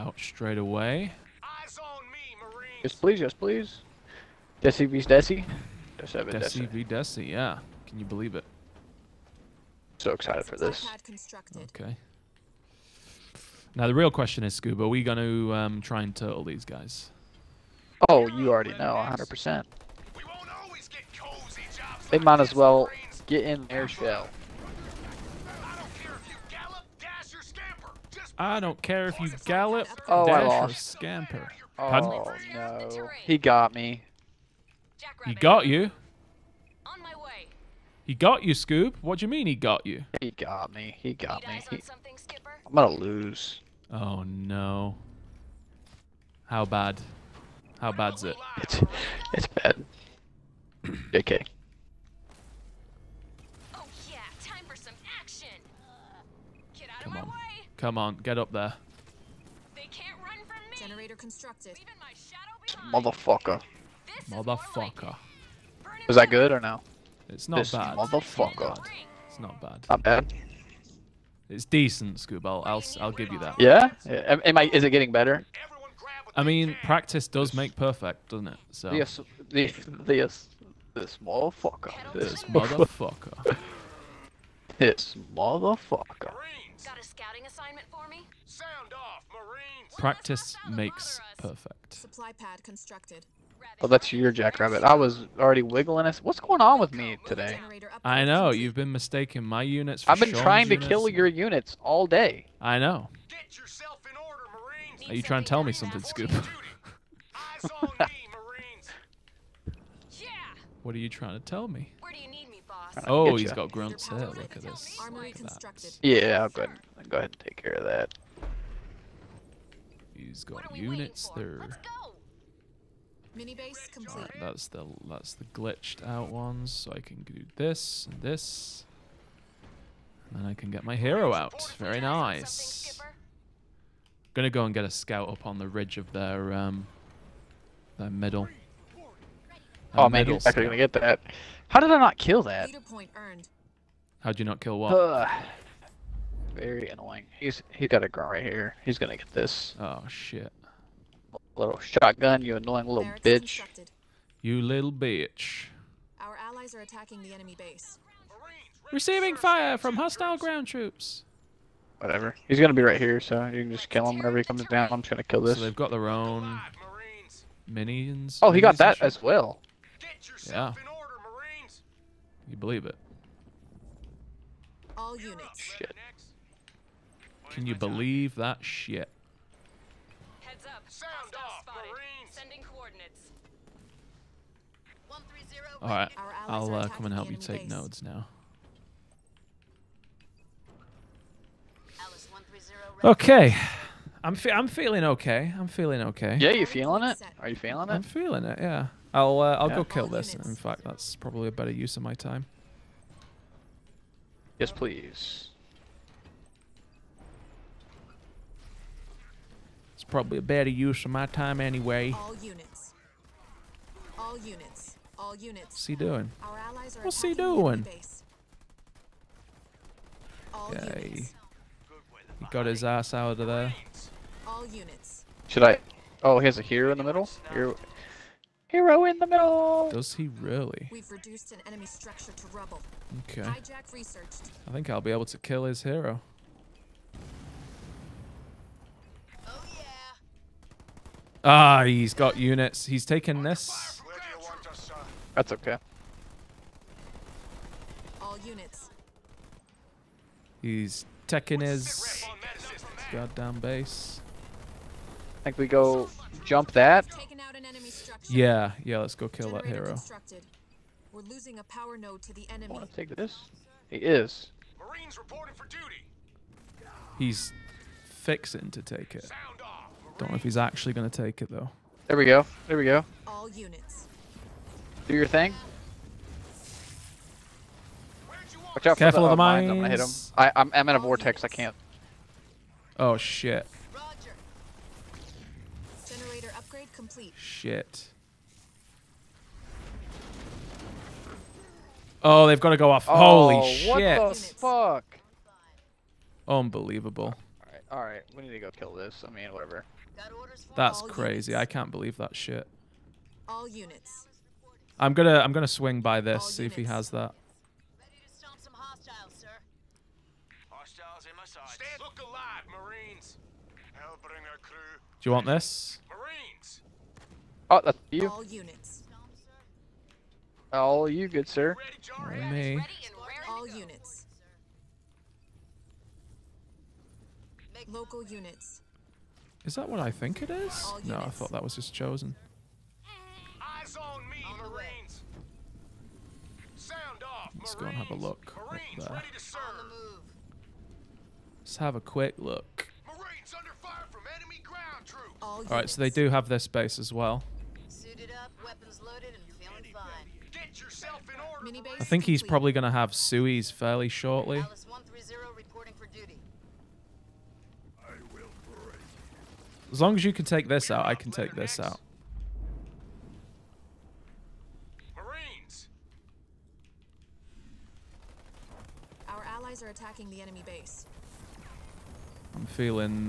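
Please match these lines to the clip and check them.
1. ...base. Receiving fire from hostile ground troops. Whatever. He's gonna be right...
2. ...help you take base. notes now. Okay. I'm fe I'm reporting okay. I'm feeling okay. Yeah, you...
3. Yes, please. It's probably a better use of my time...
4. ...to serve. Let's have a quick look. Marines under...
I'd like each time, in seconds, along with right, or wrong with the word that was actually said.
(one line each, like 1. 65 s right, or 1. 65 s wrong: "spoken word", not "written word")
1. 157 s right
2. 187 s wrong: "feeling", not "reporting"
3. 204 s right
4. 339 s right.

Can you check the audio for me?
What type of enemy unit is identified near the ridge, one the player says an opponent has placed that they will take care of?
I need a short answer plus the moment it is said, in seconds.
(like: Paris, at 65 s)
grunts, at 113 s.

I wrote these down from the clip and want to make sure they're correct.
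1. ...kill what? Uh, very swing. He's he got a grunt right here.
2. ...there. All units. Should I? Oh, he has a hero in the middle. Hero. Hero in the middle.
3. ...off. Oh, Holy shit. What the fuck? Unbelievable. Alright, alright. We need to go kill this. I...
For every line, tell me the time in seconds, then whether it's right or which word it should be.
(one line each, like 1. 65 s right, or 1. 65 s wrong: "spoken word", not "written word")
1. 144 s wrong: "annoying", not "swing"
2. 223 s right
3. 292 s right.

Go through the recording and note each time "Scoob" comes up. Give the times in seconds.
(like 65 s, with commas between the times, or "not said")
14 s, 38 s, 72 s, 106 s.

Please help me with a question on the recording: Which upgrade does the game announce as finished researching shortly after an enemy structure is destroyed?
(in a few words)
Hijack.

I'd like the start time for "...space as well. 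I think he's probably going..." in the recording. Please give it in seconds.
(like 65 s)
346 s.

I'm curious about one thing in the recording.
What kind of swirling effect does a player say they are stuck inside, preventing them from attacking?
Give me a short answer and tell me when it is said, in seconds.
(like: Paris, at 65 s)
a vortex, at 280 s.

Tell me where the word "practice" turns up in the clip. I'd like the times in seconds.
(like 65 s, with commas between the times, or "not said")
76 s, 89 s.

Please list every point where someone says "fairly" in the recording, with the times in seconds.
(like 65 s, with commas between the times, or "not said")
353 s.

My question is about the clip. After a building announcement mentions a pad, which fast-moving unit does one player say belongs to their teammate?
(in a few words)
jackrabbit.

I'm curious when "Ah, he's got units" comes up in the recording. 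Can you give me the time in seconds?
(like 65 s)
241 s.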